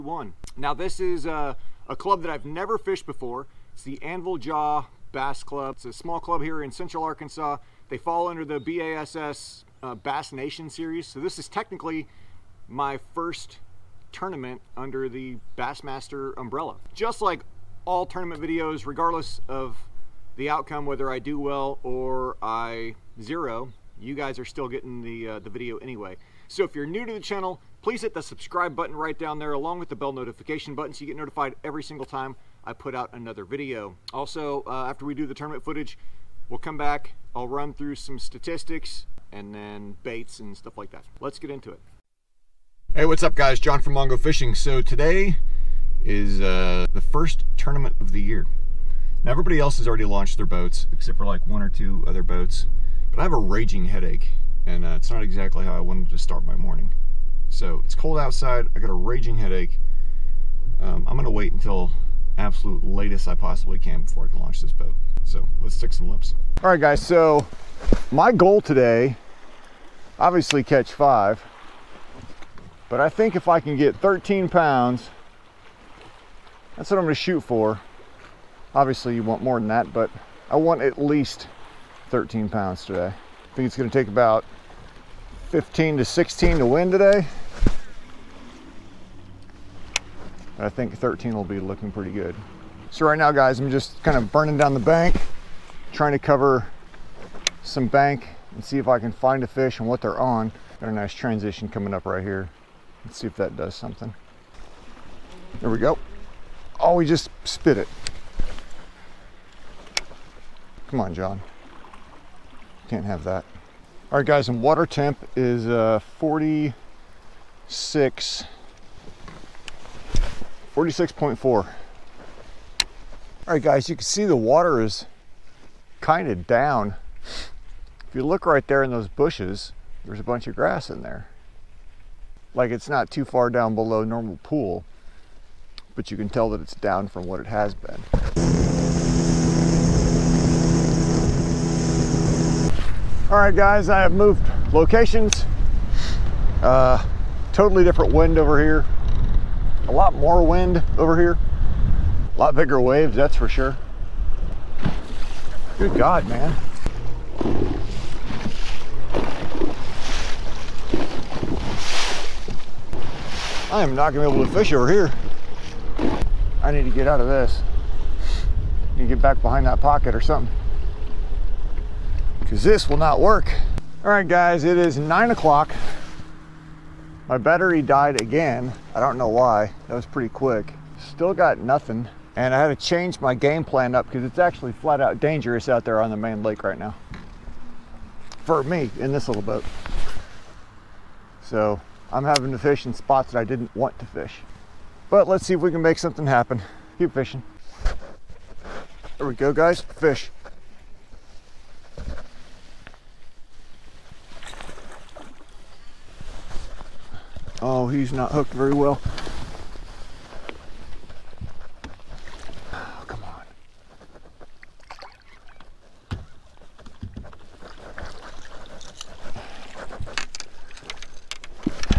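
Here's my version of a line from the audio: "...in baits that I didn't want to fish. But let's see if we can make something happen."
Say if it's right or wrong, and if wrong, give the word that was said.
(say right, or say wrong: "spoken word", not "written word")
wrong: "spots", not "baits".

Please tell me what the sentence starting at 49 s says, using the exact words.
Now everybody else has already launched their boats except for like one or two other boats.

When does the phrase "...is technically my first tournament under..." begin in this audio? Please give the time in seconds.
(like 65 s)
11 s.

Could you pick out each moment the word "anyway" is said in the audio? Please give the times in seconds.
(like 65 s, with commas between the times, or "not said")
25 s.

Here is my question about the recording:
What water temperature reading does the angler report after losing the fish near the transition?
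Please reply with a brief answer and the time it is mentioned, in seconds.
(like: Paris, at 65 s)
46.4, at 120 s.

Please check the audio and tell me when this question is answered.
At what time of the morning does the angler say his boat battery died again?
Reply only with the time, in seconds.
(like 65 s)
174 s.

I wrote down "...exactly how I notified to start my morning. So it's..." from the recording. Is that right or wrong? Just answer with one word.
wrong.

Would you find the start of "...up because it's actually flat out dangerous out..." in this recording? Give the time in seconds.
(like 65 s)
183 s.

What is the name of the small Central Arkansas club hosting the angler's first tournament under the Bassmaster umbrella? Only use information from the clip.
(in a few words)
Anvil Jaw Bass Club.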